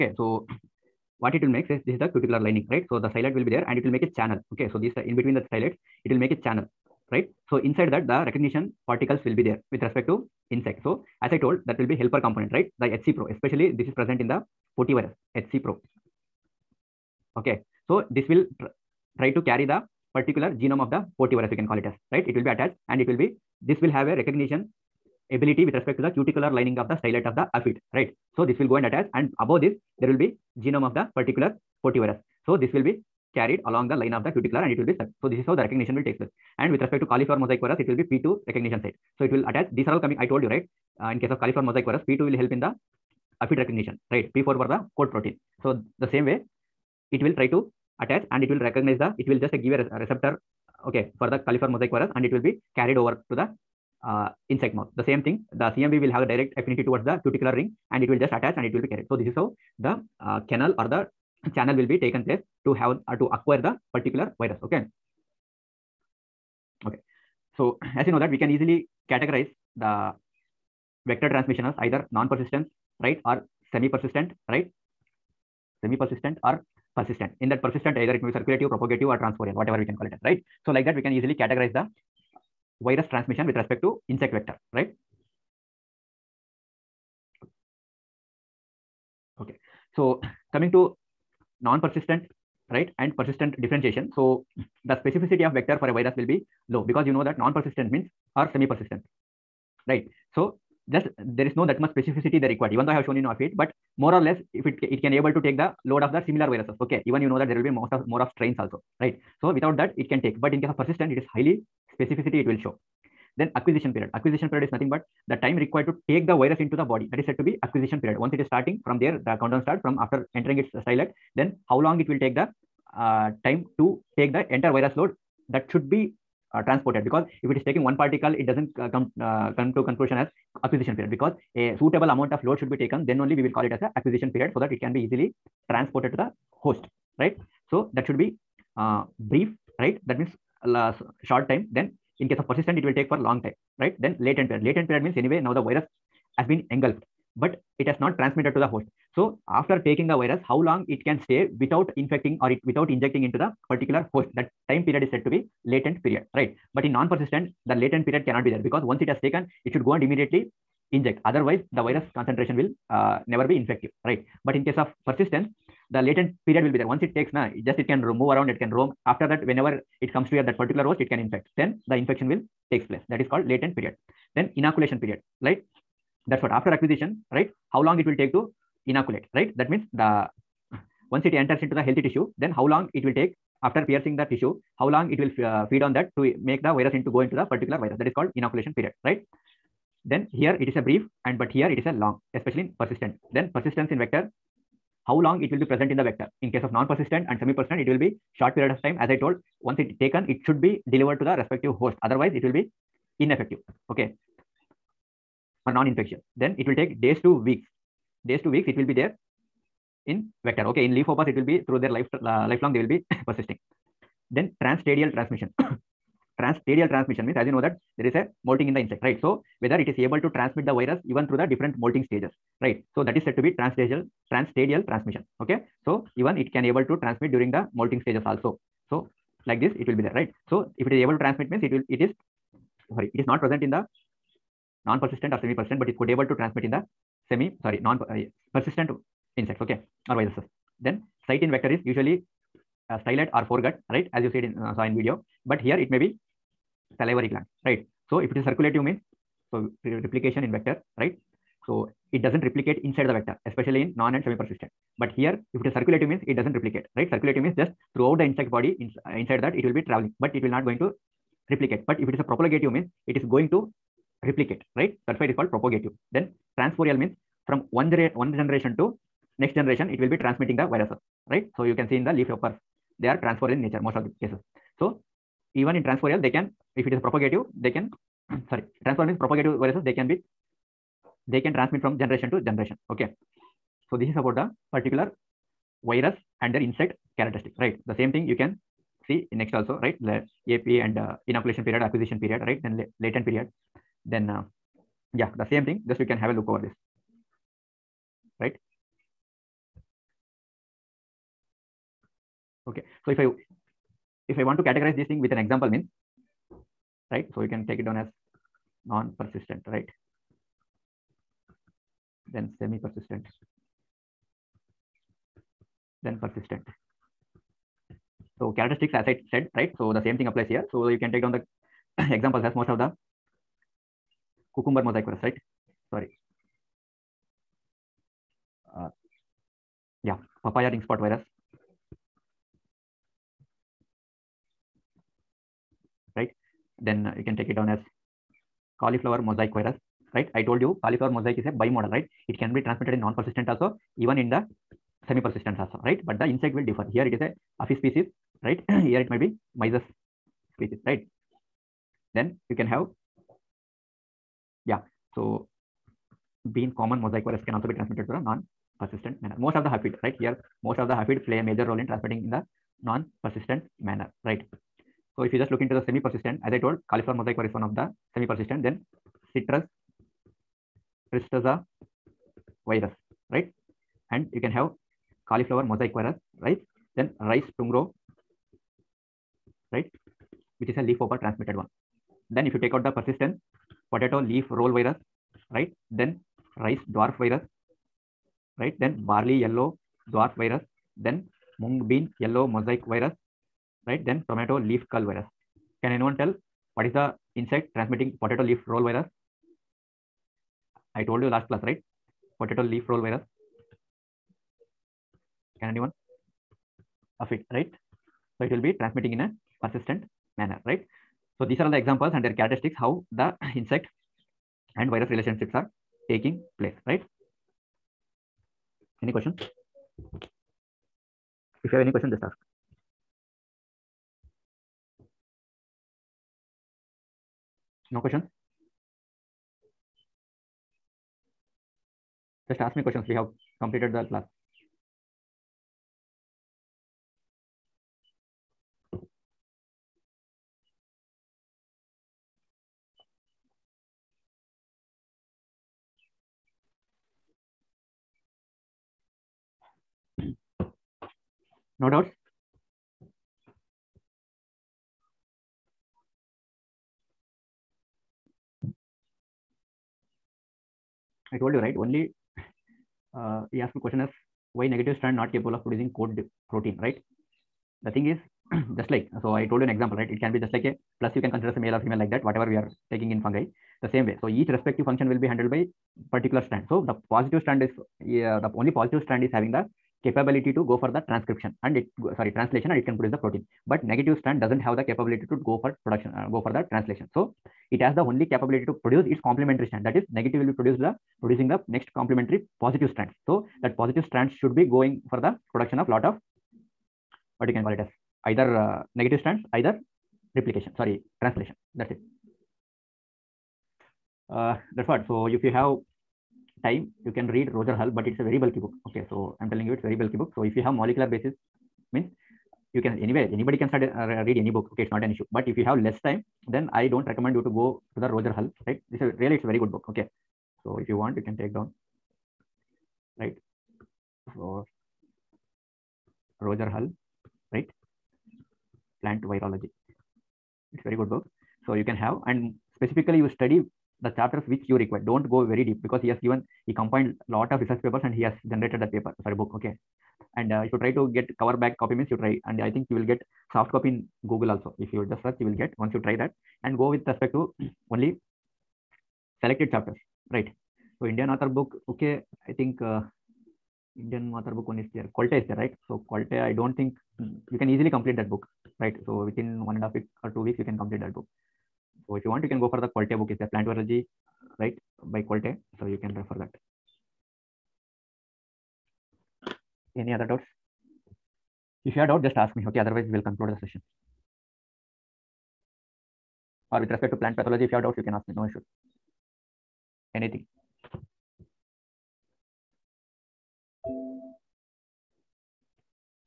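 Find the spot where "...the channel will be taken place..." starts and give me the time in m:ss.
1:00.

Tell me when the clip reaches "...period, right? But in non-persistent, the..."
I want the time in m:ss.
2:36.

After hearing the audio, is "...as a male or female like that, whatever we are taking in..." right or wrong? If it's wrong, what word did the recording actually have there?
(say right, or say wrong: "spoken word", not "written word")
right.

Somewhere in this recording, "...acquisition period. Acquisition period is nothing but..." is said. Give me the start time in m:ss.
1:53.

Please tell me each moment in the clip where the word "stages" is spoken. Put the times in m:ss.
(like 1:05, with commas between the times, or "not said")
3:42, 3:48.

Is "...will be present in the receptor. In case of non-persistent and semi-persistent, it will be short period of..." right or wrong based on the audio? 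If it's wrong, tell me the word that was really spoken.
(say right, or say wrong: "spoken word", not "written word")
wrong: "vector", not "receptor".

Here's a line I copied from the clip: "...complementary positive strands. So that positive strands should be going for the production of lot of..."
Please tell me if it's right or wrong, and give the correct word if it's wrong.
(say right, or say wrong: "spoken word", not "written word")
right.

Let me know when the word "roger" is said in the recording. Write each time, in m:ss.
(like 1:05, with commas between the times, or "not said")
8:27, 8:38, 8:46.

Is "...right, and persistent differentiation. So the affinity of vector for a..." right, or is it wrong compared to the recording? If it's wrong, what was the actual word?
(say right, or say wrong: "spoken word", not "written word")
wrong: "specificity", not "affinity".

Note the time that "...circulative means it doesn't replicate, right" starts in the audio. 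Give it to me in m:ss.
4:15.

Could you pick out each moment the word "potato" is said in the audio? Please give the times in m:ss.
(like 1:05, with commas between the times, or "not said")
6:23, 6:38, 6:42.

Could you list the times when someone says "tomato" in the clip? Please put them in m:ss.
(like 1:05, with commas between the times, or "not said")
6:34.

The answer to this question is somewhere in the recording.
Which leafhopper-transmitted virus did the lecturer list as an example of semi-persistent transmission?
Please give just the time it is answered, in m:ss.
6:17.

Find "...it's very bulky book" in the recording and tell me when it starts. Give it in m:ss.
8:29.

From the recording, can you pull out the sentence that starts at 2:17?
So that should be uh, brief, right?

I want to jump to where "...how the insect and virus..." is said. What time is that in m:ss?
6:52.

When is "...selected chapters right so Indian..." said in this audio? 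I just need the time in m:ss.
9:09.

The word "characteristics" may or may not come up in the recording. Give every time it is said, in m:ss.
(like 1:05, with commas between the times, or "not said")
4:47, 5:18, 6:52.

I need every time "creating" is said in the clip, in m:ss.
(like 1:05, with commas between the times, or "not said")
not said.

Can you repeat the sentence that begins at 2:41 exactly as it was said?
Otherwise, the virus concentration will uh, never be infective, right?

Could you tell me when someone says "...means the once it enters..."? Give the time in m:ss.
2:59.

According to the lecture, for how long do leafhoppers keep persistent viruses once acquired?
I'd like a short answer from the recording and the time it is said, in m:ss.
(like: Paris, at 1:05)
lifelong, at 3:32.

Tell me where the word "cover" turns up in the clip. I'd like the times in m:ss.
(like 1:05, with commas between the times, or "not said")
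9:01.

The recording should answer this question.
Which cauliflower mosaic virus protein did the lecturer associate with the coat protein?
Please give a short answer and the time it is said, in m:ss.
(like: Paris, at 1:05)
P4, at 0:44.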